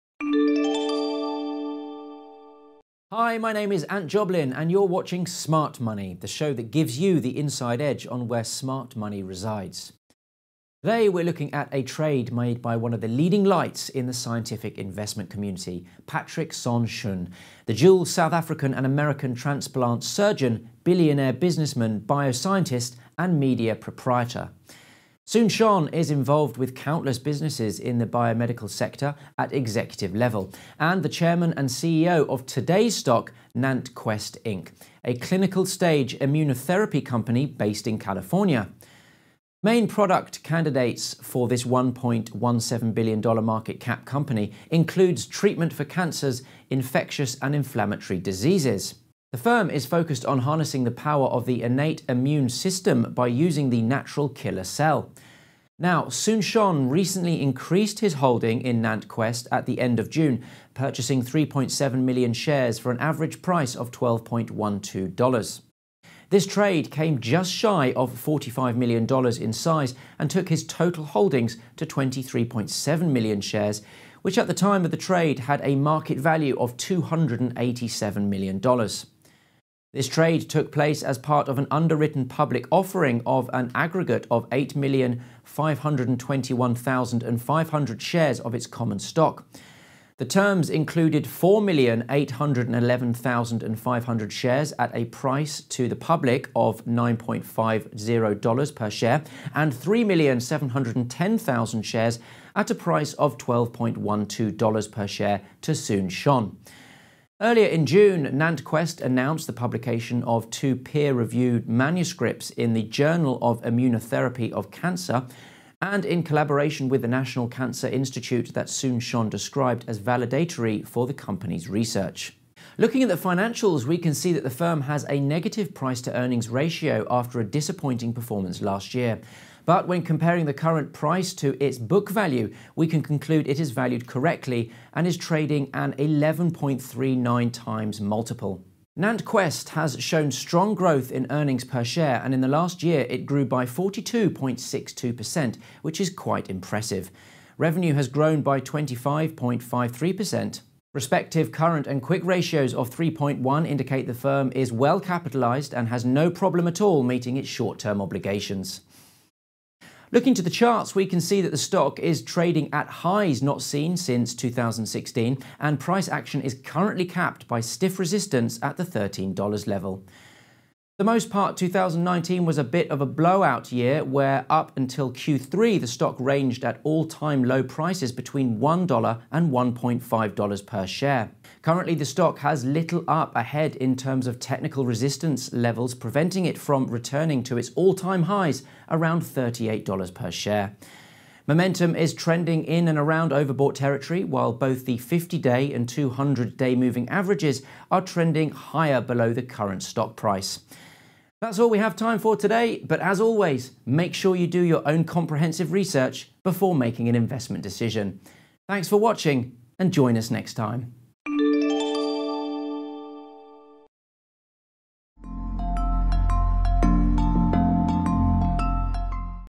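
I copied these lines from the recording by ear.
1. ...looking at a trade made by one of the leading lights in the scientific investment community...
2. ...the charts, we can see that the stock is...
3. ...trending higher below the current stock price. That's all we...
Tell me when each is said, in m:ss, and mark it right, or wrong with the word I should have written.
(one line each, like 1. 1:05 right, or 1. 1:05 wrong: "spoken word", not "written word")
1. 0:11 right
2. 2:40 right
3. 3:18 right.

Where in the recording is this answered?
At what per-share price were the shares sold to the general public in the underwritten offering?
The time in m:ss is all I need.
1:36.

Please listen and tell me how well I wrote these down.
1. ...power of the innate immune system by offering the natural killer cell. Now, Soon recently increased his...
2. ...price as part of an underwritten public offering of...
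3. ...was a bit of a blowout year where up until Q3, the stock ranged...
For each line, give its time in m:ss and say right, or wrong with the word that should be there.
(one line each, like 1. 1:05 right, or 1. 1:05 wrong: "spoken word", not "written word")
1. 0:50 wrong: "using", not "offering"
2. 1:20 wrong: "place", not "price"
3. 2:52 right.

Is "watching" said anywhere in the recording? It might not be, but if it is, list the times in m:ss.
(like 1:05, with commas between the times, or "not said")
0:04, 3:28.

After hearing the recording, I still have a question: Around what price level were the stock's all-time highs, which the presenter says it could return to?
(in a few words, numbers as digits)
$38.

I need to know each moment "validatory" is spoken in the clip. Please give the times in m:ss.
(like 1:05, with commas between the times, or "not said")
1:59.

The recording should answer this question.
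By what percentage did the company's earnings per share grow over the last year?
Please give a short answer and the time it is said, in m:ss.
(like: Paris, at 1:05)
42.62%, at 2:23.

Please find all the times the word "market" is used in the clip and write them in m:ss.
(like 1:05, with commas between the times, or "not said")
0:43, 1:15.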